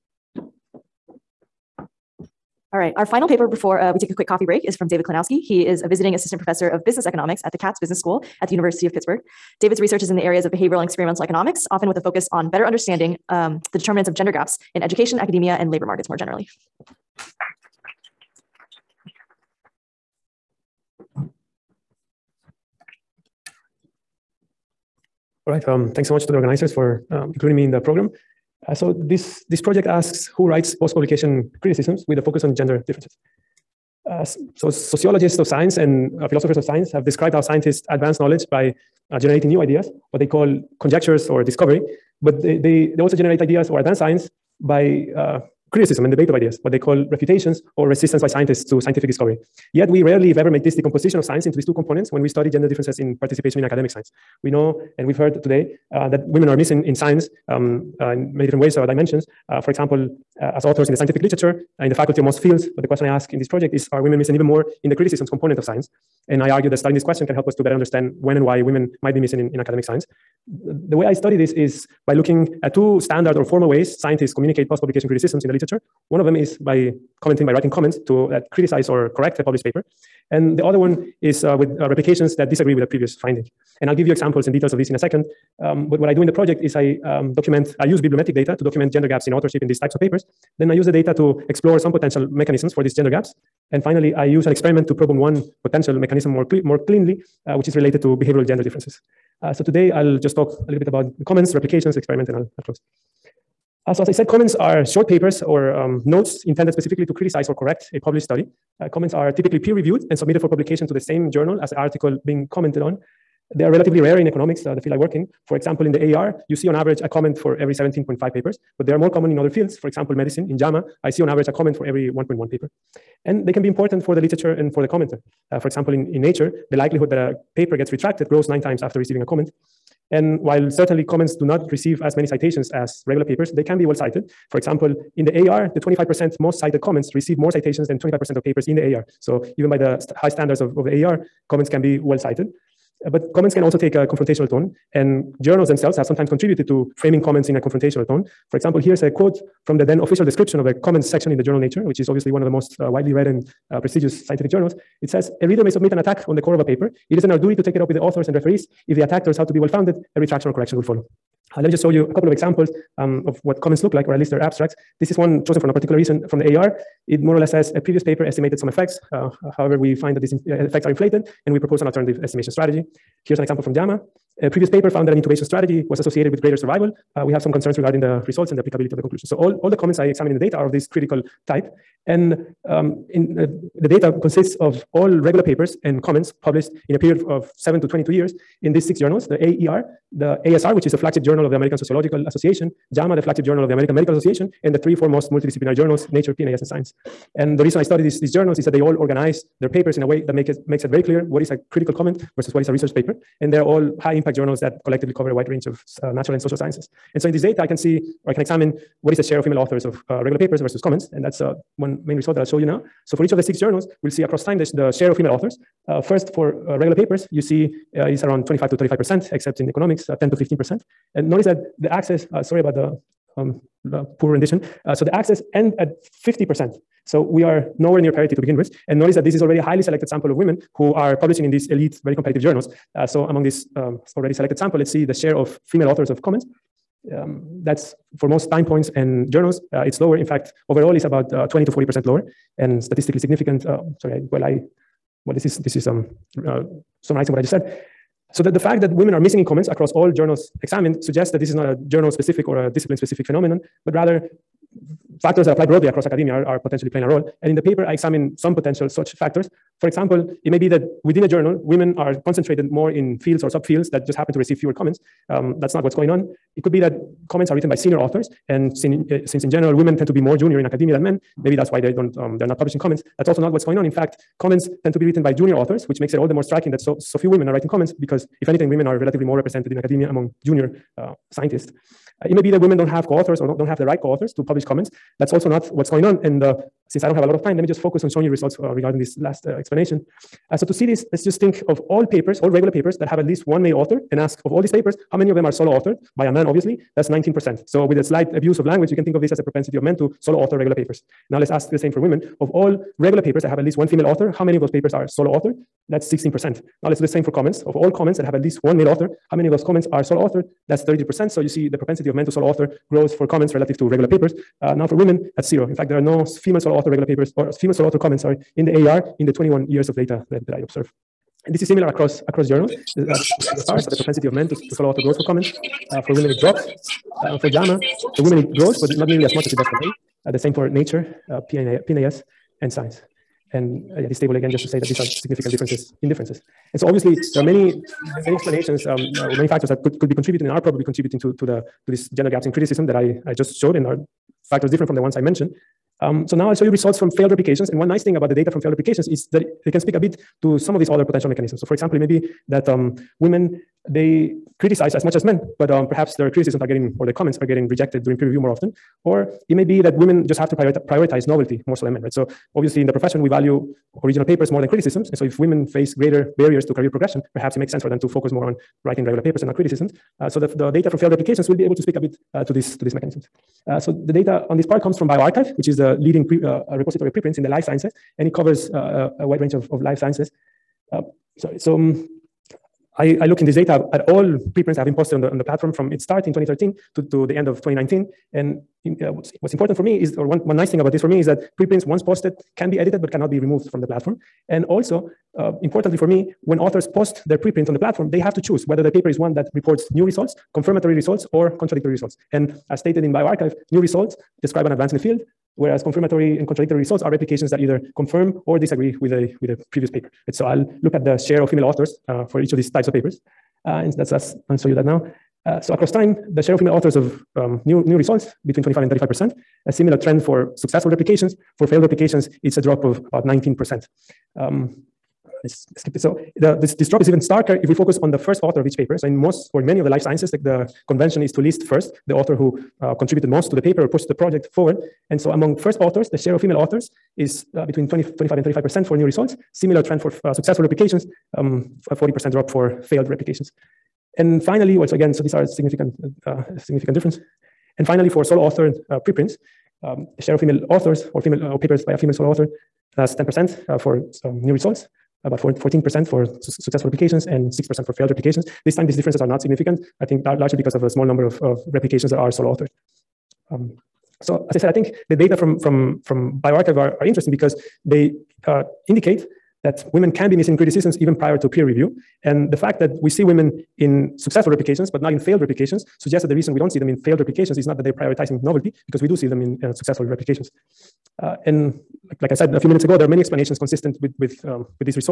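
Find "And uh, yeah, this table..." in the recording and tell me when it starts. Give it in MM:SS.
05:33.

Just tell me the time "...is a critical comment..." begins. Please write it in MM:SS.
03:21.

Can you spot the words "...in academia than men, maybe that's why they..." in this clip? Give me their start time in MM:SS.
04:30.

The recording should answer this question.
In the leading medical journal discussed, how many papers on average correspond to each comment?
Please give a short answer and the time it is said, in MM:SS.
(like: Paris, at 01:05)
1.1, at 02:02.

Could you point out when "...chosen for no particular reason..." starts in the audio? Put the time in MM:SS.
02:45.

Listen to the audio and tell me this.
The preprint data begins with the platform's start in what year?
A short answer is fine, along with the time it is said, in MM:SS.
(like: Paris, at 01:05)
2013, at 06:26.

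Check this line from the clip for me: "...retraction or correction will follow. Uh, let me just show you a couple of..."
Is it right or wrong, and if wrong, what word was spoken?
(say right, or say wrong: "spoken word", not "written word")
right.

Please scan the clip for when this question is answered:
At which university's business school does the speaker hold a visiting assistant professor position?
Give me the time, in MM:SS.
00:08.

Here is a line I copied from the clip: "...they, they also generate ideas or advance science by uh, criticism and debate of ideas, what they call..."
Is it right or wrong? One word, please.
right.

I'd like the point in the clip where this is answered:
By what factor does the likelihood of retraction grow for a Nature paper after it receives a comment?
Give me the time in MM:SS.
02:08.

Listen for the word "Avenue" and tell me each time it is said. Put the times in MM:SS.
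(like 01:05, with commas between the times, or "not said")
not said.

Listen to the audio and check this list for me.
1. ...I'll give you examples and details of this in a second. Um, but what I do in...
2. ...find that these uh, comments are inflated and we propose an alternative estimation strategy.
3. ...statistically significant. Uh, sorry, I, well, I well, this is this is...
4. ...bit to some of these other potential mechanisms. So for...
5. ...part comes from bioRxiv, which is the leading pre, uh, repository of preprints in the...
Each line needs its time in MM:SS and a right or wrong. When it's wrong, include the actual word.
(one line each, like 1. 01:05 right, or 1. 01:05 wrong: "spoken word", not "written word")
1. 01:23 right
2. 02:49 wrong: "effects", not "comments"
3. 04:02 right
4. 05:49 right
5. 06:14 right.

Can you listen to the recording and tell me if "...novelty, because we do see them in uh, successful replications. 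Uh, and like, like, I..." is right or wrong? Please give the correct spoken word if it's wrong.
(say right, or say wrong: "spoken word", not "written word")
right.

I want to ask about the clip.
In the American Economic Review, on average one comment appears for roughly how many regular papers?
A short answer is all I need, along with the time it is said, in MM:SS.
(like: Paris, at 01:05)
17.5, at 01:57.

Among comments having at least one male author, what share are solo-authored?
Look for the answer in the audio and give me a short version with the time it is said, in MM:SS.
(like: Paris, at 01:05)
33%, at 05:10.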